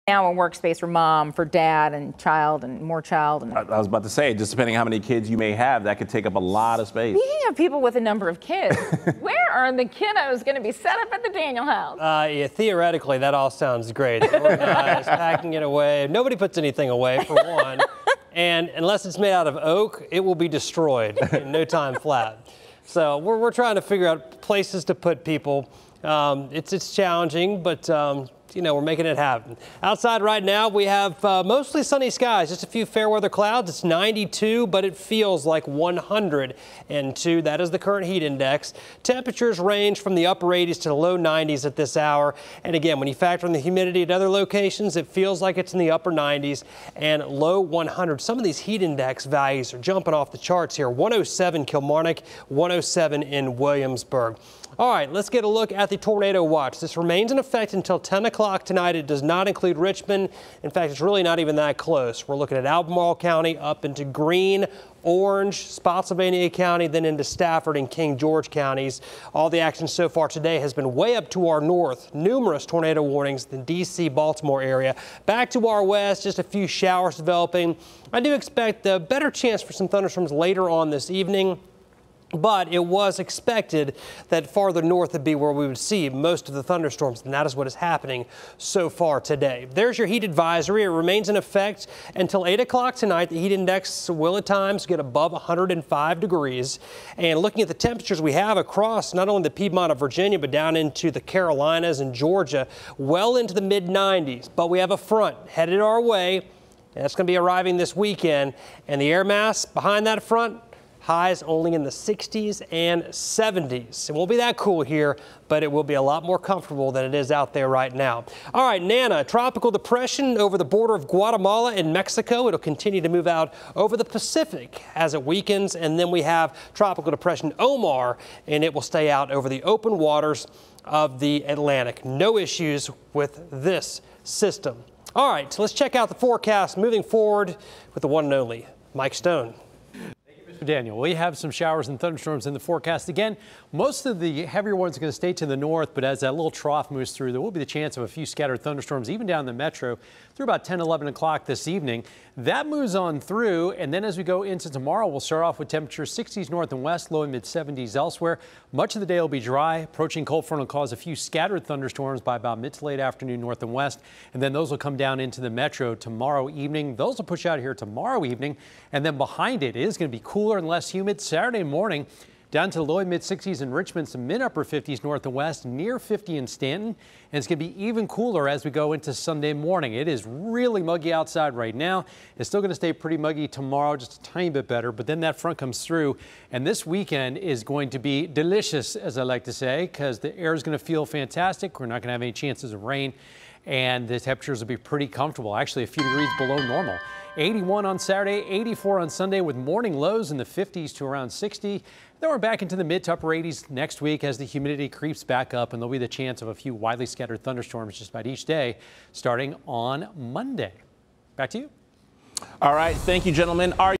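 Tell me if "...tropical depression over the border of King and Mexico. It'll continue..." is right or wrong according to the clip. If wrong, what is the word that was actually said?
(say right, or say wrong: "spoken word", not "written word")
wrong: "Guatemala", not "King".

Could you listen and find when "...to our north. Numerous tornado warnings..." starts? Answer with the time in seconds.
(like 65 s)
71 s.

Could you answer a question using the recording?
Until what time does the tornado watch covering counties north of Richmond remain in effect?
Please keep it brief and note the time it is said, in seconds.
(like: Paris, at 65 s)
10 o'clock tonight, at 57 s.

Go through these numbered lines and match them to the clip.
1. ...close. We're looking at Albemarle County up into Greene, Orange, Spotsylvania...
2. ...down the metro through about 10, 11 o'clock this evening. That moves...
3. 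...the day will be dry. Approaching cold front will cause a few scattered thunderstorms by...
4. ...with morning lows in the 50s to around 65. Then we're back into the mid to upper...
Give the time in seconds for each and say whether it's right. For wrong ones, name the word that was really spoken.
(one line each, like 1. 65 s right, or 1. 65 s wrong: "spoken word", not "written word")
1. 61 s right
2. 149 s right
3. 159 s right
4. 199 s wrong: "60", not "65".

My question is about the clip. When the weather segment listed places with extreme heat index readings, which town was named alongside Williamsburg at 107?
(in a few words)
Kilmarnock.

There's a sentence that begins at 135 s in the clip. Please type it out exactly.
All right, so let's check out the forecast moving forward with the one and only Mike Stone.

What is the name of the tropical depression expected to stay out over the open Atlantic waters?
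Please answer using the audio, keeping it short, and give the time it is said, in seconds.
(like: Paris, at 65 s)
Omar, at 127 s.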